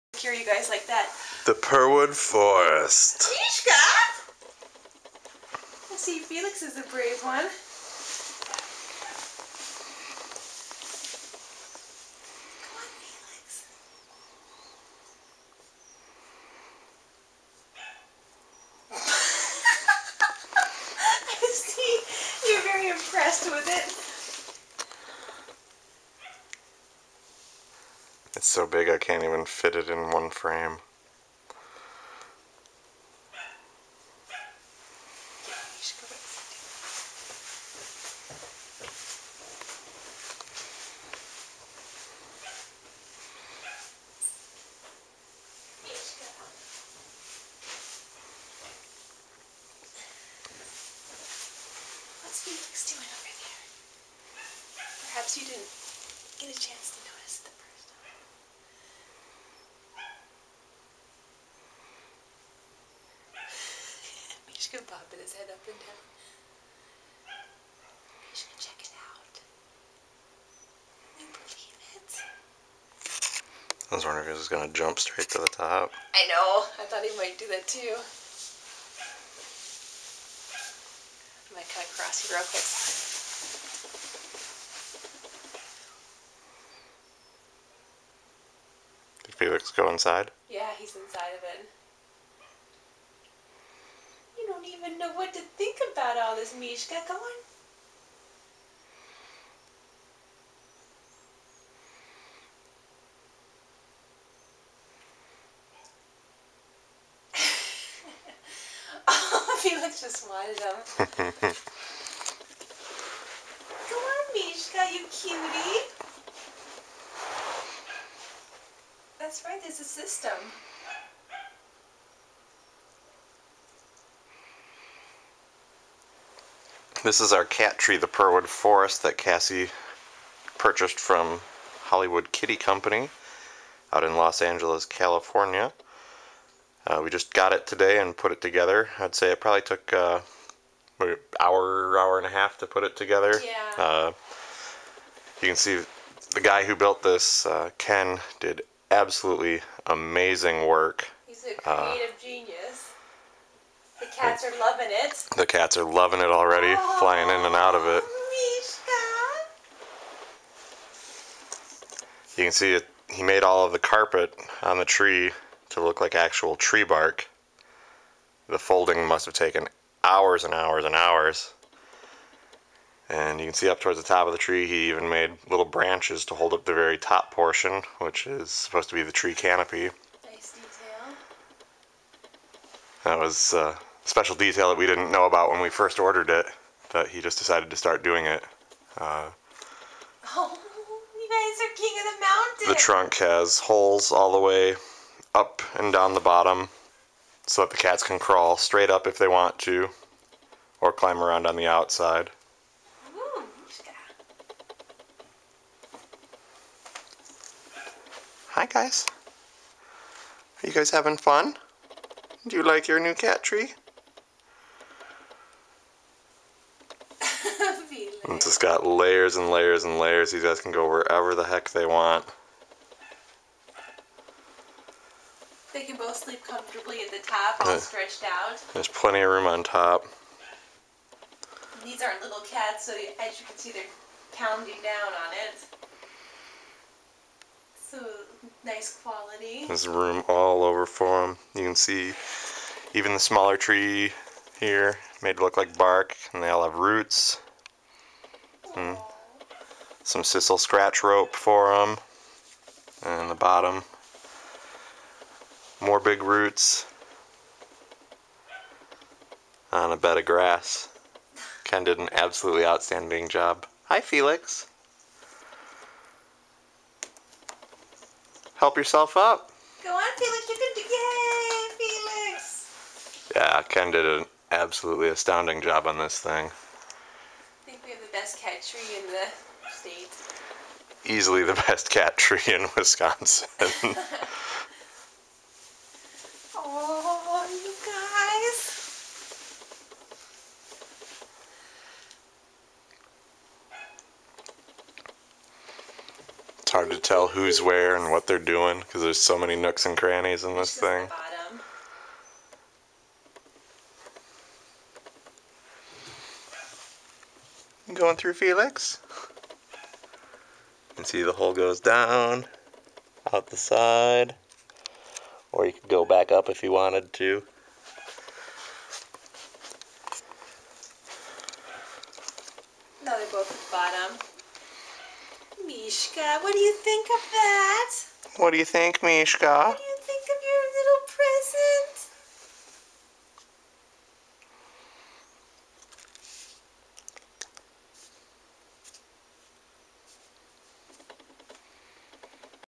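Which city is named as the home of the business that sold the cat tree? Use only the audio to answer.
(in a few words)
Los Angeles.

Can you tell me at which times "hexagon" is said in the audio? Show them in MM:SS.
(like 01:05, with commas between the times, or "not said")
not said.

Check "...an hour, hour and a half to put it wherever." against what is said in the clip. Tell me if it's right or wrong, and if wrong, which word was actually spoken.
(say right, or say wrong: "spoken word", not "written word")
wrong: "together", not "wherever".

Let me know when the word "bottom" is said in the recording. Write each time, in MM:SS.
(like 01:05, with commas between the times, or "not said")
03:16, 04:13, 05:23.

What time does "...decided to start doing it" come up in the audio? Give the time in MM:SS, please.
03:07.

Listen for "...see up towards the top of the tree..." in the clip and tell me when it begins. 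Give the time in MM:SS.
02:53.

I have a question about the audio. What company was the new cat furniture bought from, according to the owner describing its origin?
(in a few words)
Hollywood Kitty Company.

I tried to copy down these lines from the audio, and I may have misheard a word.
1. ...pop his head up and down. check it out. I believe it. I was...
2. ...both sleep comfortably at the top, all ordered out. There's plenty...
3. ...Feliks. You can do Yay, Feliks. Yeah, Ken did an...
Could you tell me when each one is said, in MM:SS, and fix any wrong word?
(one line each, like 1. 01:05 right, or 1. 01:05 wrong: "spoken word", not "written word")
1. 01:04 right
2. 03:45 wrong: "stretched", not "ordered"
3. 04:30 right.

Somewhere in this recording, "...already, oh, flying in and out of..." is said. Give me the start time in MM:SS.
02:36.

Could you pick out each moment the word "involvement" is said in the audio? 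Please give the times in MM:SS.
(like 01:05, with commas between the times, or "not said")
not said.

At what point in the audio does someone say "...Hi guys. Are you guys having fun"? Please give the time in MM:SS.
03:28.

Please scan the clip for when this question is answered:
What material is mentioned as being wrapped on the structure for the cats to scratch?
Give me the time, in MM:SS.
04:10.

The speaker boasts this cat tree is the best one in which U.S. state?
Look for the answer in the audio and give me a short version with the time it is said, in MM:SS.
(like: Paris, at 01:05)
Wisconsin, at 04:42.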